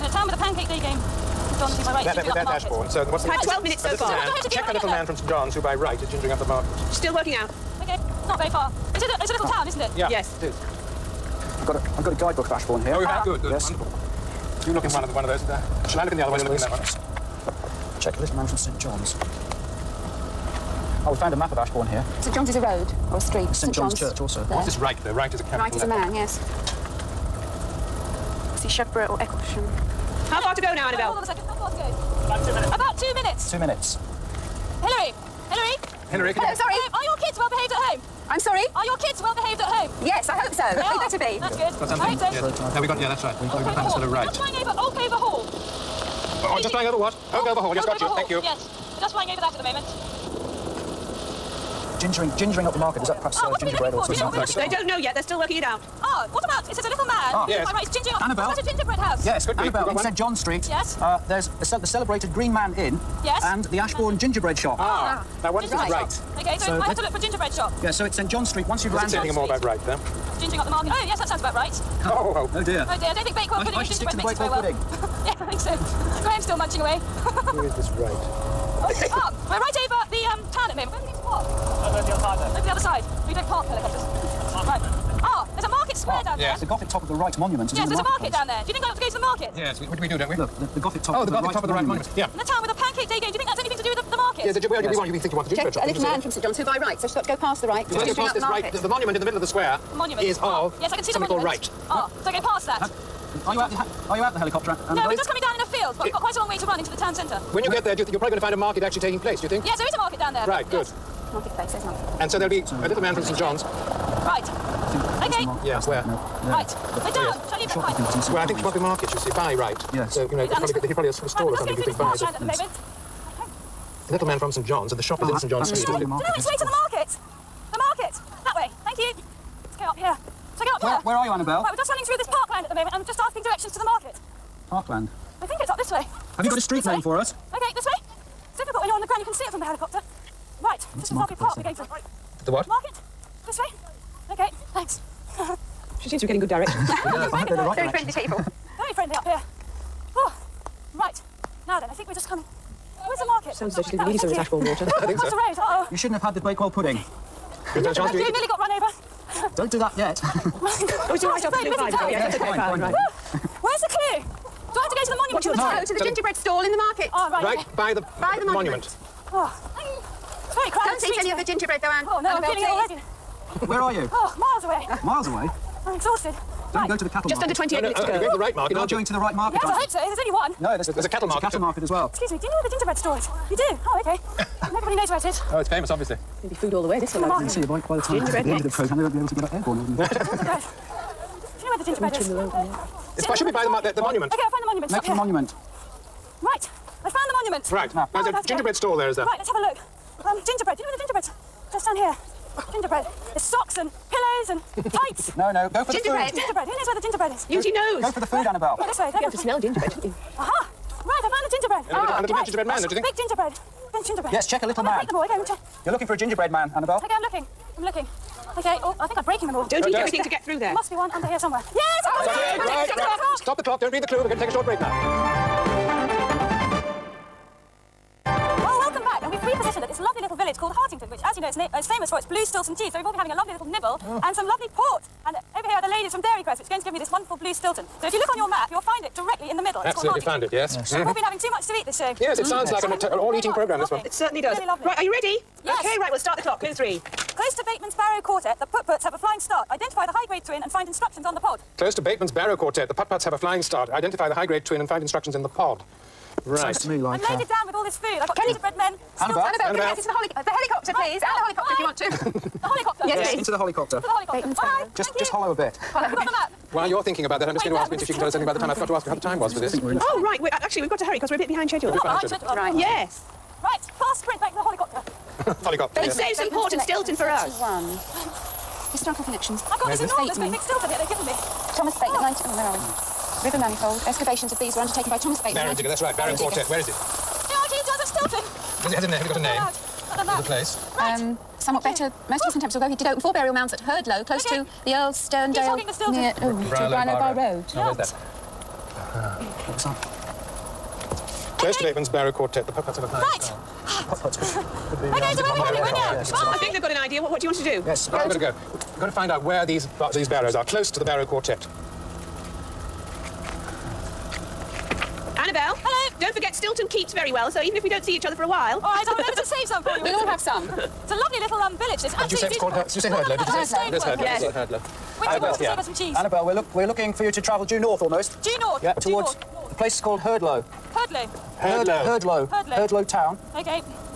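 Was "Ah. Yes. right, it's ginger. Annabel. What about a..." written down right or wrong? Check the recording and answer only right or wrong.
right.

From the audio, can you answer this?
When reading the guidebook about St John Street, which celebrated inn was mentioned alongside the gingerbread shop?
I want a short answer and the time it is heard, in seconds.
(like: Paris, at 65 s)
Green Man Inn, at 62 s.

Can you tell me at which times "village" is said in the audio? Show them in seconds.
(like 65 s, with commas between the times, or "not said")
230 s, 321 s.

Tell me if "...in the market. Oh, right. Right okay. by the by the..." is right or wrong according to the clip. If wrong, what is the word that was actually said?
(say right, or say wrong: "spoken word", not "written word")
right.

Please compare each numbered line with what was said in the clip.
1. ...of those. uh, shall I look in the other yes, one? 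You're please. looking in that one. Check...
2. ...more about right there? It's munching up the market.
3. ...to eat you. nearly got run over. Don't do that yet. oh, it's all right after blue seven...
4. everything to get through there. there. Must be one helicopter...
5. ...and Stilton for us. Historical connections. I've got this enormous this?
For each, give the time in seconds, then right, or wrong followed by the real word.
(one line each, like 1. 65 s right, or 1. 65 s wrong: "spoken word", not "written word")
1. 15 s right
2. 69 s wrong: "gingering", not "munching"
3. 158 s wrong: "five", not "seven"
4. 219 s wrong: "under", not "helicopter"
5. 276 s right.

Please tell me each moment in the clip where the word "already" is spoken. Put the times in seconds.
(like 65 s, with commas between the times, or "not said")
173 s.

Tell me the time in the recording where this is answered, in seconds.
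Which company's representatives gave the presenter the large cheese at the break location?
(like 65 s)
236 s.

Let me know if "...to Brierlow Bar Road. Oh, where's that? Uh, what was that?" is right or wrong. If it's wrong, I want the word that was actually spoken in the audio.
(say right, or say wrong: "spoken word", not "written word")
right.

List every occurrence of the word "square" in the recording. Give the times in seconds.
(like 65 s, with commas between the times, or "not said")
86 s, 99 s.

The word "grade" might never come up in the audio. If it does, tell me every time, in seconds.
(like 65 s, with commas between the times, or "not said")
250 s, 254 s.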